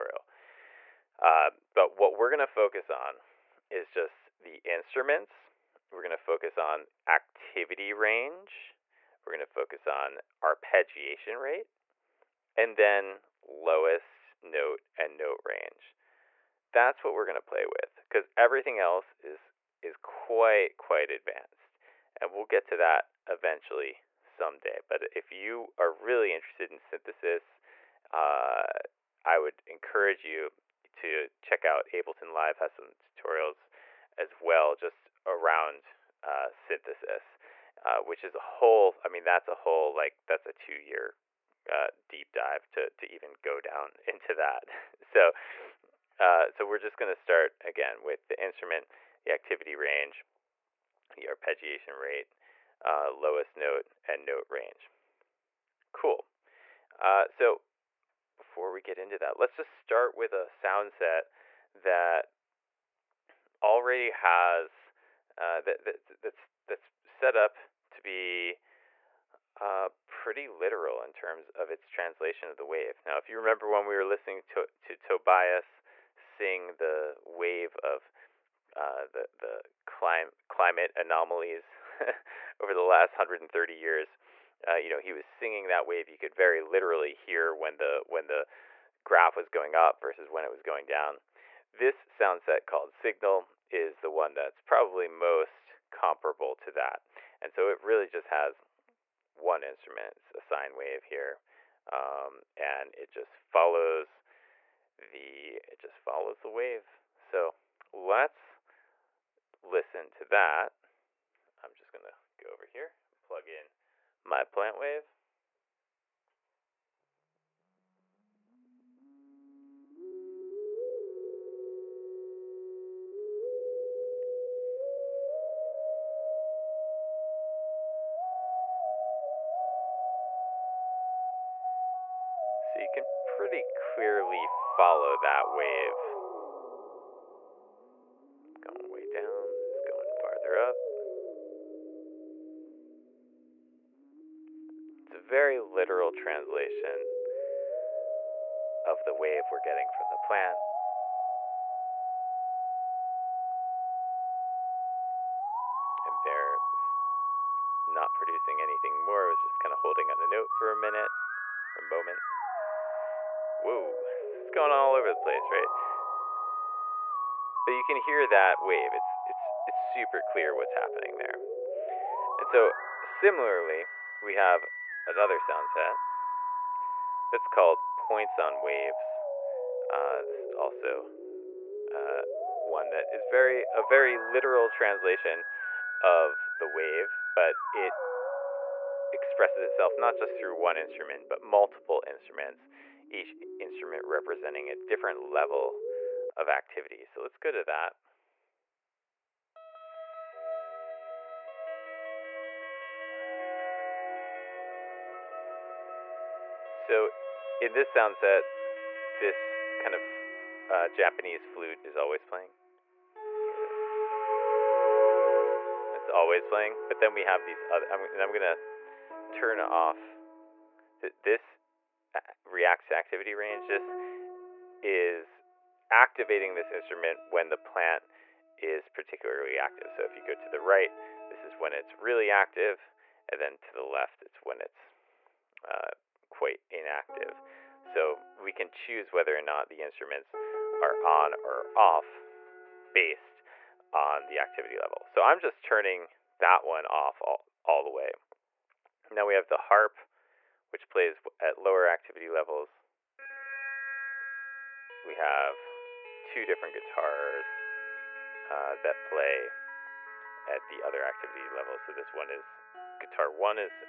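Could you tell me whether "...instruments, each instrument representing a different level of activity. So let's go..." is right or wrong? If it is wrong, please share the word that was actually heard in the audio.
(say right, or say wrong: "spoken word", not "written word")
right.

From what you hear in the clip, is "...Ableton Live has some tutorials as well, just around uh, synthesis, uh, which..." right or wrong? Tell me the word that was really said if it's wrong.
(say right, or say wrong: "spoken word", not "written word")
right.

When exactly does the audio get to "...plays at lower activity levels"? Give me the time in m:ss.
4:10.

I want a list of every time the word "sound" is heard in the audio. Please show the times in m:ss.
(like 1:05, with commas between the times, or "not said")
1:00, 1:32, 2:55, 3:27.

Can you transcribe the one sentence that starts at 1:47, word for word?
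So let's listen to that, I'm just going to go over here plug in my plant wave.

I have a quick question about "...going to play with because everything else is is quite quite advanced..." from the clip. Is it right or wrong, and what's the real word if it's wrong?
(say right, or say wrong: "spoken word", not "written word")
right.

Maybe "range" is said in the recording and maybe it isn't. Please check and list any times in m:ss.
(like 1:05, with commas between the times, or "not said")
0:07, 0:15, 0:49, 0:54, 3:43.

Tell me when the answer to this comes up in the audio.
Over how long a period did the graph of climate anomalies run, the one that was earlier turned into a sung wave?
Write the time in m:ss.
1:23.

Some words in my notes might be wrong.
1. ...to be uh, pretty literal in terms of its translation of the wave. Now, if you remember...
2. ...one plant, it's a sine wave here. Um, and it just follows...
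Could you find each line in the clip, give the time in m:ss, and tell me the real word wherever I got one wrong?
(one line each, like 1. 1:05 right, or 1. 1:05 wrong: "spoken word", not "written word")
1. 1:07 right
2. 1:39 wrong: "instrument", not "plant".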